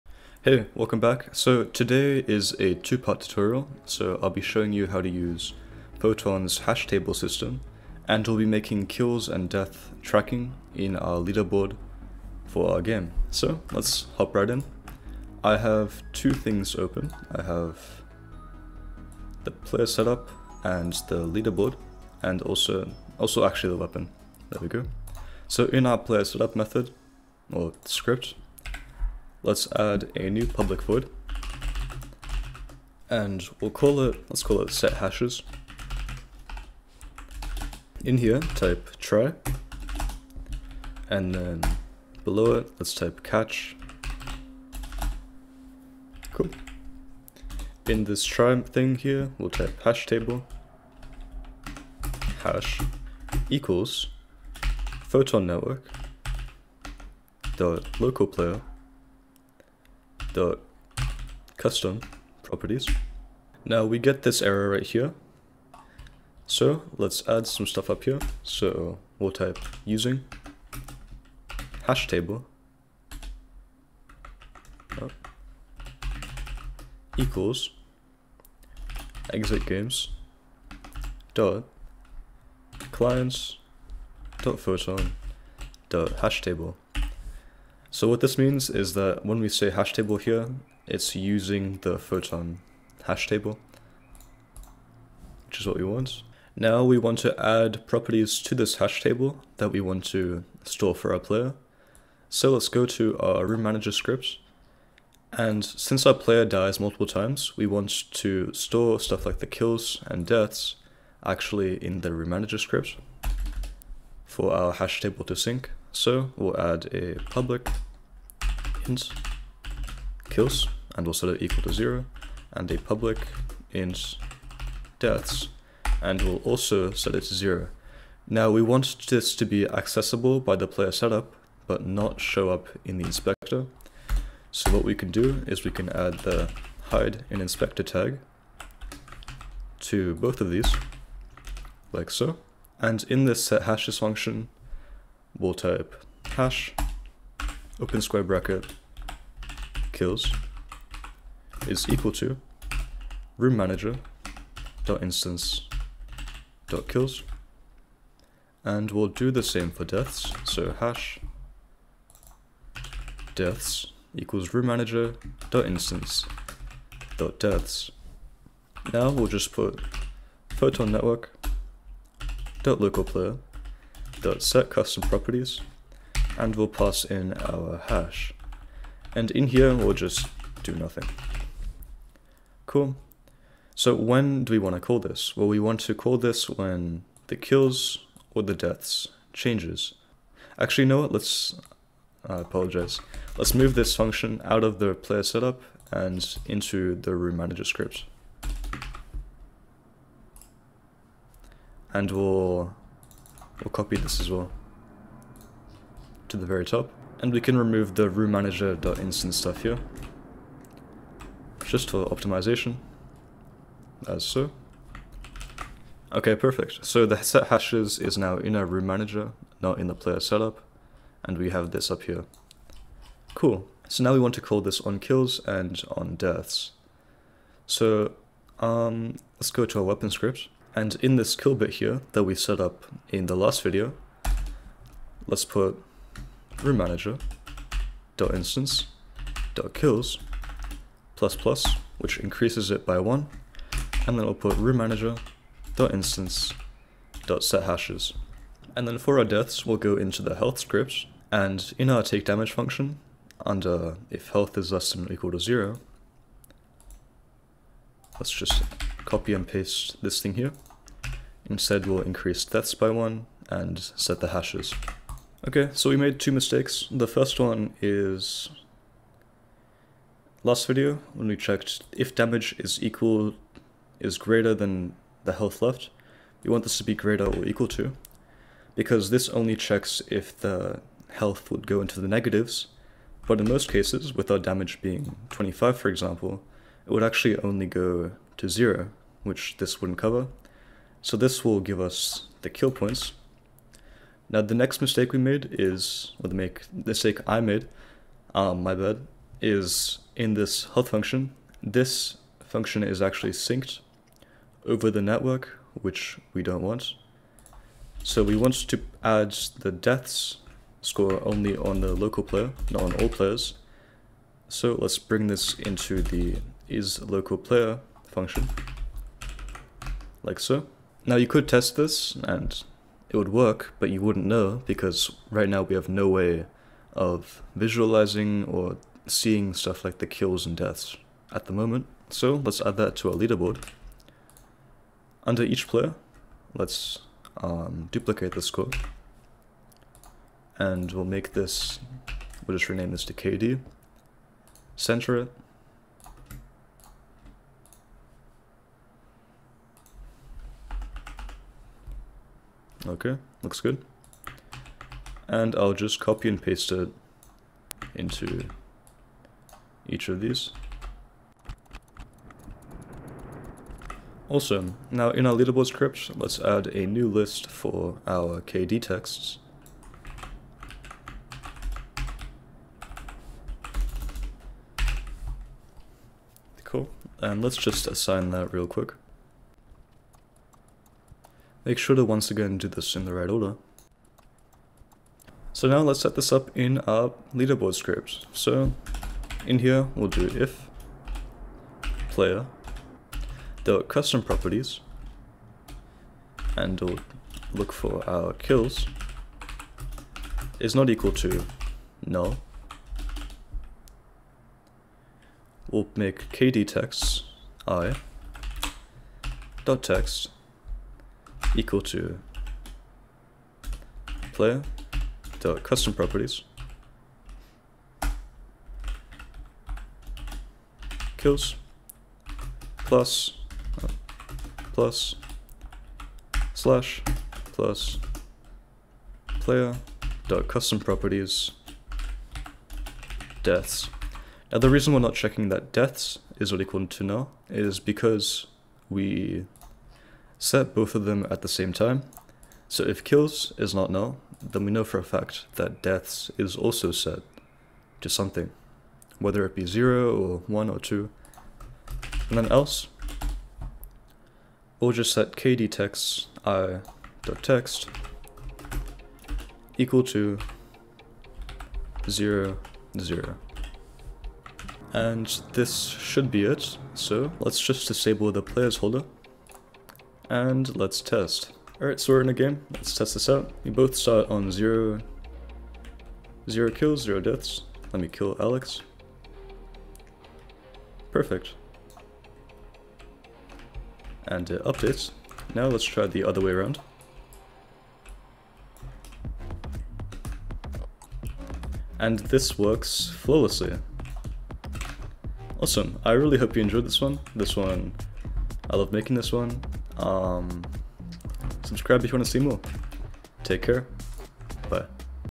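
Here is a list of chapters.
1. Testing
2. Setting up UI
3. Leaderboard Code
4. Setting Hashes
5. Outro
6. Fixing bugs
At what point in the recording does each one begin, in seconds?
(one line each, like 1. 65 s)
1. 471 s
2. 321 s
3. 367 s
4. 15 s
5. 495 s
6. 264 s.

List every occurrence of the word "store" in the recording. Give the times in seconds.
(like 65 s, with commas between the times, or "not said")
100 s, 108 s.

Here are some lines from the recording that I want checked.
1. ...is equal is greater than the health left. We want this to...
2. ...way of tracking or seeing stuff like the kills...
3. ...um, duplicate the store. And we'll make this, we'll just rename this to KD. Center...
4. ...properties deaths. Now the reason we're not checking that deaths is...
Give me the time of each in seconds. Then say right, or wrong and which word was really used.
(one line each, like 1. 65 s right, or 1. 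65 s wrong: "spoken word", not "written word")
1. 272 s right
2. 326 s wrong: "visualizing", not "tracking"
3. 337 s wrong: "score", not "store"
4. 430 s right.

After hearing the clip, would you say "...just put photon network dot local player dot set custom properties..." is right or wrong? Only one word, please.
right.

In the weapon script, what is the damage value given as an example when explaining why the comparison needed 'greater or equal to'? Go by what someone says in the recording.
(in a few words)
25.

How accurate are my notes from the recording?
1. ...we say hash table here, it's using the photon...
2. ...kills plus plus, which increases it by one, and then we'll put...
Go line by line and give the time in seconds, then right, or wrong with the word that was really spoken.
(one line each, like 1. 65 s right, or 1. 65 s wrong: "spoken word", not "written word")
1. 89 s right
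2. 239 s right.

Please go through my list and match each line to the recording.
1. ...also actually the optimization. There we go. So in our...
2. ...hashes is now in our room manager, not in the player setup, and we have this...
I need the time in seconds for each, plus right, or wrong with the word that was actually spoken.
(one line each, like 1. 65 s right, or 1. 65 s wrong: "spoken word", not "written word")
1. 23 s wrong: "weapon", not "optimization"
2. 217 s right.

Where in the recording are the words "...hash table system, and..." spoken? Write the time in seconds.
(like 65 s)
6 s.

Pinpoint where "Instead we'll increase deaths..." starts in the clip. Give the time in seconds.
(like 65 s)
261 s.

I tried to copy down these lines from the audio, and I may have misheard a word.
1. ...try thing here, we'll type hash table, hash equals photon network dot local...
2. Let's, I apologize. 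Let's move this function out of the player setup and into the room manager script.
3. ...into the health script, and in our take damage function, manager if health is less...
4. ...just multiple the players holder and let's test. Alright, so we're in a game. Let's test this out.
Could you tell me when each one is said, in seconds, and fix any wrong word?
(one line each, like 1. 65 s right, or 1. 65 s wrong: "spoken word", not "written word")
1. 48 s right
2. 191 s right
3. 249 s wrong: "under", not "manager"
4. 467 s wrong: "disable", not "multiple".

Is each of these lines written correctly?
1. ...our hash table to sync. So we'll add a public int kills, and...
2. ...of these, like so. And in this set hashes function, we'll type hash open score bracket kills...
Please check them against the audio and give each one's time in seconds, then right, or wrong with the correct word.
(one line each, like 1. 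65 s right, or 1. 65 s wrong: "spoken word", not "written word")
1. 114 s right
2. 140 s wrong: "square", not "score".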